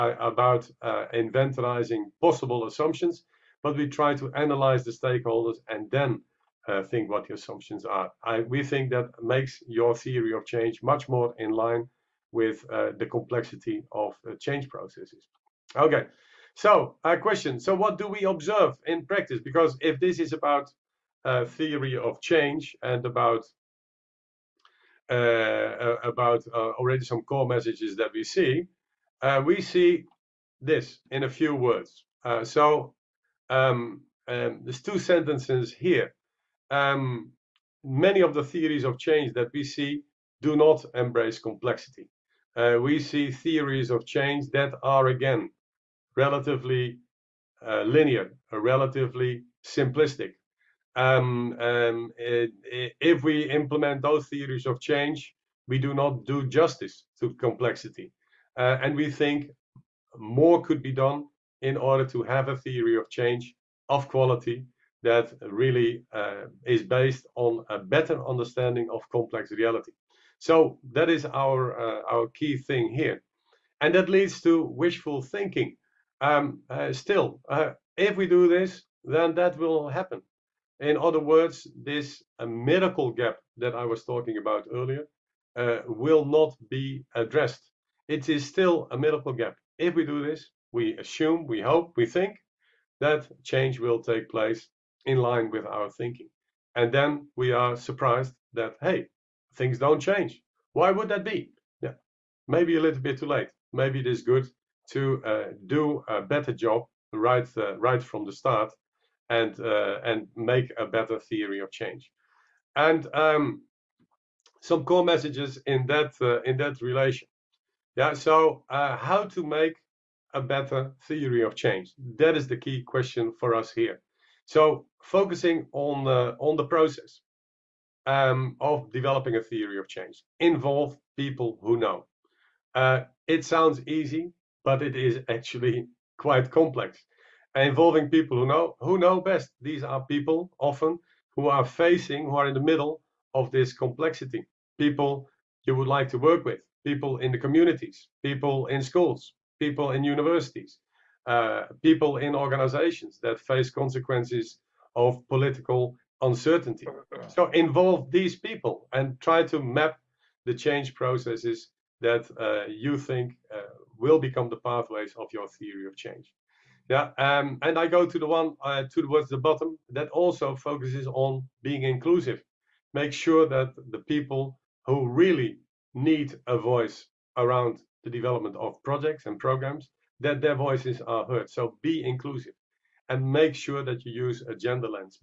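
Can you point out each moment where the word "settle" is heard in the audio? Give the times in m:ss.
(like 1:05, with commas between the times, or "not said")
not said.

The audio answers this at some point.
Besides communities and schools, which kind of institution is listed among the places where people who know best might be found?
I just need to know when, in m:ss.
2:30.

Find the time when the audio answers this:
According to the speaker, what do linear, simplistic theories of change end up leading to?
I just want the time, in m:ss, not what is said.
1:14.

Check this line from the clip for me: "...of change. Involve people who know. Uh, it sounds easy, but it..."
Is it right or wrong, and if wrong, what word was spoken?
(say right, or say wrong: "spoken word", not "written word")
right.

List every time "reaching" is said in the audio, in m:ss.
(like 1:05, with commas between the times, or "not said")
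not said.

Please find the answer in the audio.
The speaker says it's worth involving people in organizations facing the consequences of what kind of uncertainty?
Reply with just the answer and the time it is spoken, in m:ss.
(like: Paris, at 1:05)
political uncertainty, at 2:35.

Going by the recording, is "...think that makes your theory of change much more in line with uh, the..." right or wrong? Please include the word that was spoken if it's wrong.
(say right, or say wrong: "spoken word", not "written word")
right.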